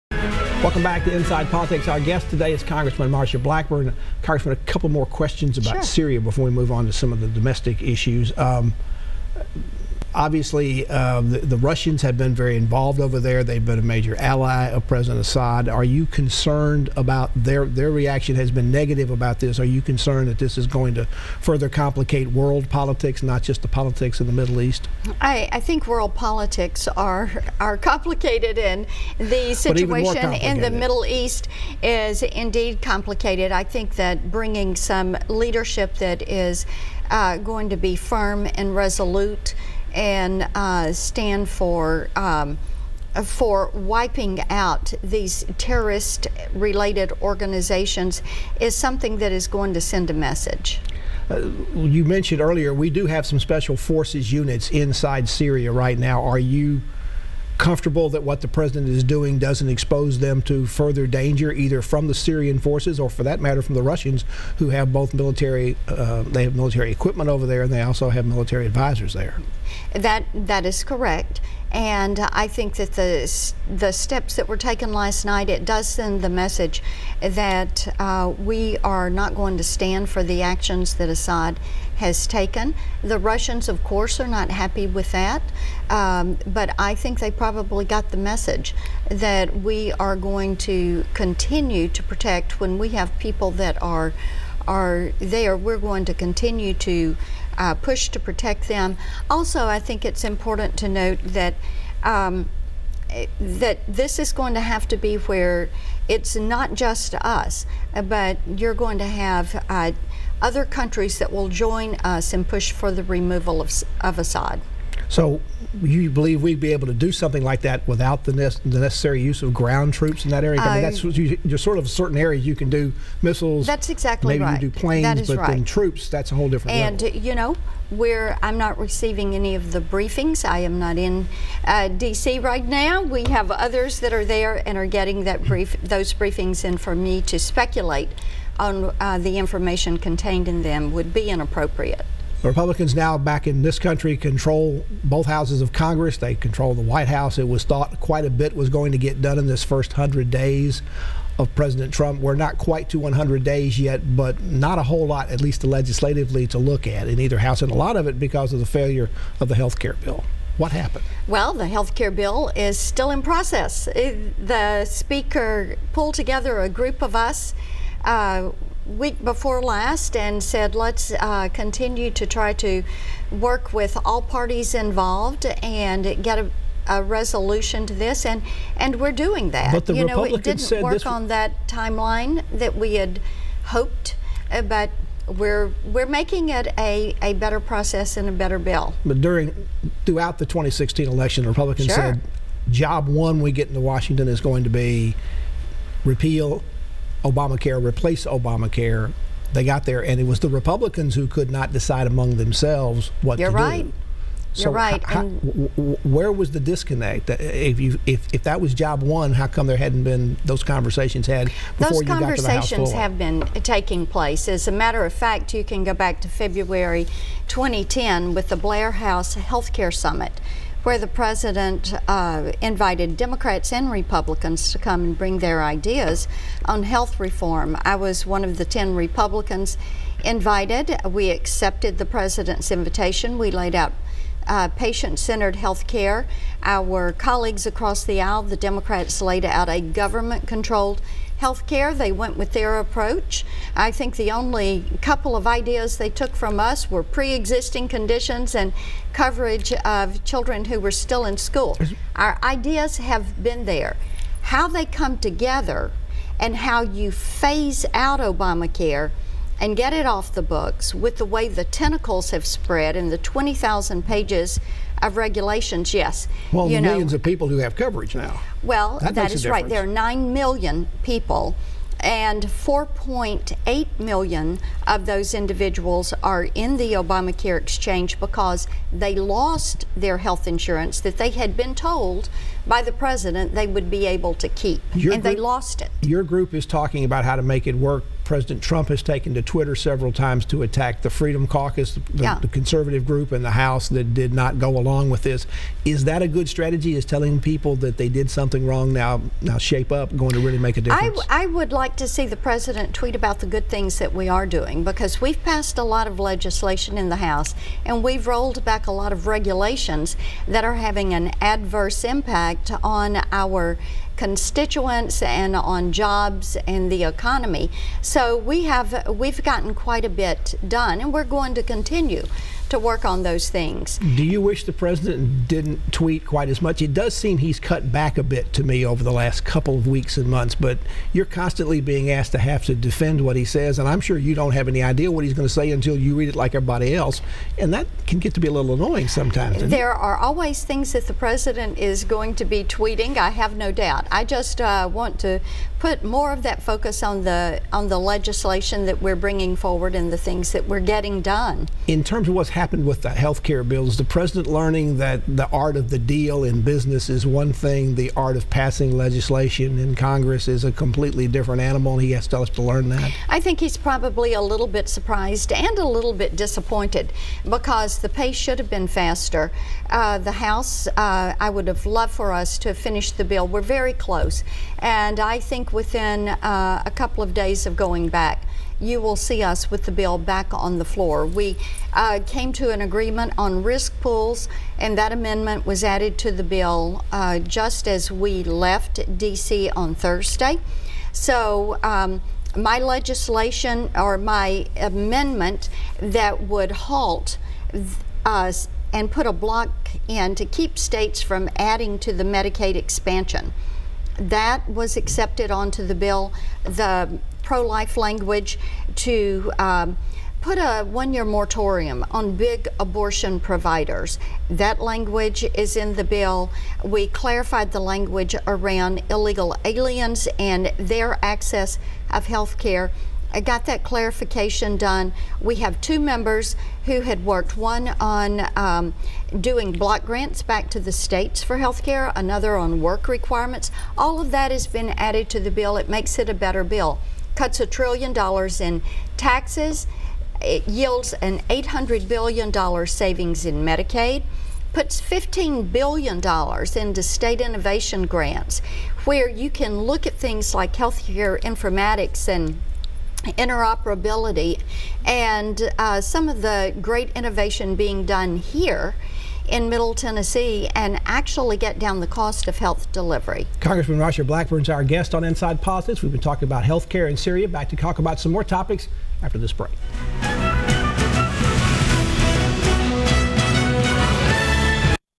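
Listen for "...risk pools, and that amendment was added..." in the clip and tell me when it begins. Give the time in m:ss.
6:23.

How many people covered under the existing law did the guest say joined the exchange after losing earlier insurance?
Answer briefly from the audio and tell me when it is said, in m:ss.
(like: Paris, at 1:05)
4.8 million, at 4:32.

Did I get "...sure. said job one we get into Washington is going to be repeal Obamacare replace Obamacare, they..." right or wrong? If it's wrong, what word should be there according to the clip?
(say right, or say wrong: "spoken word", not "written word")
right.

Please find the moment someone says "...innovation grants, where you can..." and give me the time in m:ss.
7:27.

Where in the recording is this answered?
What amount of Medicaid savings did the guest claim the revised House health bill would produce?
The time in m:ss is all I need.
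7:21.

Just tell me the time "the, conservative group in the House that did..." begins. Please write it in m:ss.
4:52.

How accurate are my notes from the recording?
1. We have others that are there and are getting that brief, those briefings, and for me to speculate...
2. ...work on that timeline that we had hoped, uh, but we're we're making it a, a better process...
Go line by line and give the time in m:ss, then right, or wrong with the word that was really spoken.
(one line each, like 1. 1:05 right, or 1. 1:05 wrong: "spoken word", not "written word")
1. 2:13 right
2. 3:00 right.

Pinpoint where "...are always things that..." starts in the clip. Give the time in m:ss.
5:39.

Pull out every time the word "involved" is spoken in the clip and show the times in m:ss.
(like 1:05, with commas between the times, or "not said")
0:12, 2:54.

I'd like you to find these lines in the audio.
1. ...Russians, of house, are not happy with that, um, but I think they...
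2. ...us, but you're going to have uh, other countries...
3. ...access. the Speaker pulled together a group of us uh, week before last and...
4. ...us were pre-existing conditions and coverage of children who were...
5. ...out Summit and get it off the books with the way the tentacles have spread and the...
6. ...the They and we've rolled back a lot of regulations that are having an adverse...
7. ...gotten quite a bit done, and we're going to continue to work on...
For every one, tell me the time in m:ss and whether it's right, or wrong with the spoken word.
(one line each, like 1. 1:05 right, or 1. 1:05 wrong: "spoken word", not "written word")
1. 1:23 wrong: "course", not "house"
2. 1:47 right
3. 2:43 wrong: "process", not "access"
4. 4:06 right
5. 4:17 wrong: "Obamacare", not "Summit"
6. 5:07 wrong: "House", not "They"
7. 5:19 right.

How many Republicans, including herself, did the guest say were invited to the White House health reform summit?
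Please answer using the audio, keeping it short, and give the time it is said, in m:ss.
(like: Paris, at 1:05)
10, at 3:48.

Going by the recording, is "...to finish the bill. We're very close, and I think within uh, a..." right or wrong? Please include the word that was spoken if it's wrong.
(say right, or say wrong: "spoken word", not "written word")
right.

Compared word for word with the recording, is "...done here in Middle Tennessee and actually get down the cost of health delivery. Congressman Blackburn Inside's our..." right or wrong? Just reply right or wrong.
wrong.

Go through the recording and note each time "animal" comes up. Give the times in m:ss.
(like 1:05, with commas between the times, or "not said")
6:01.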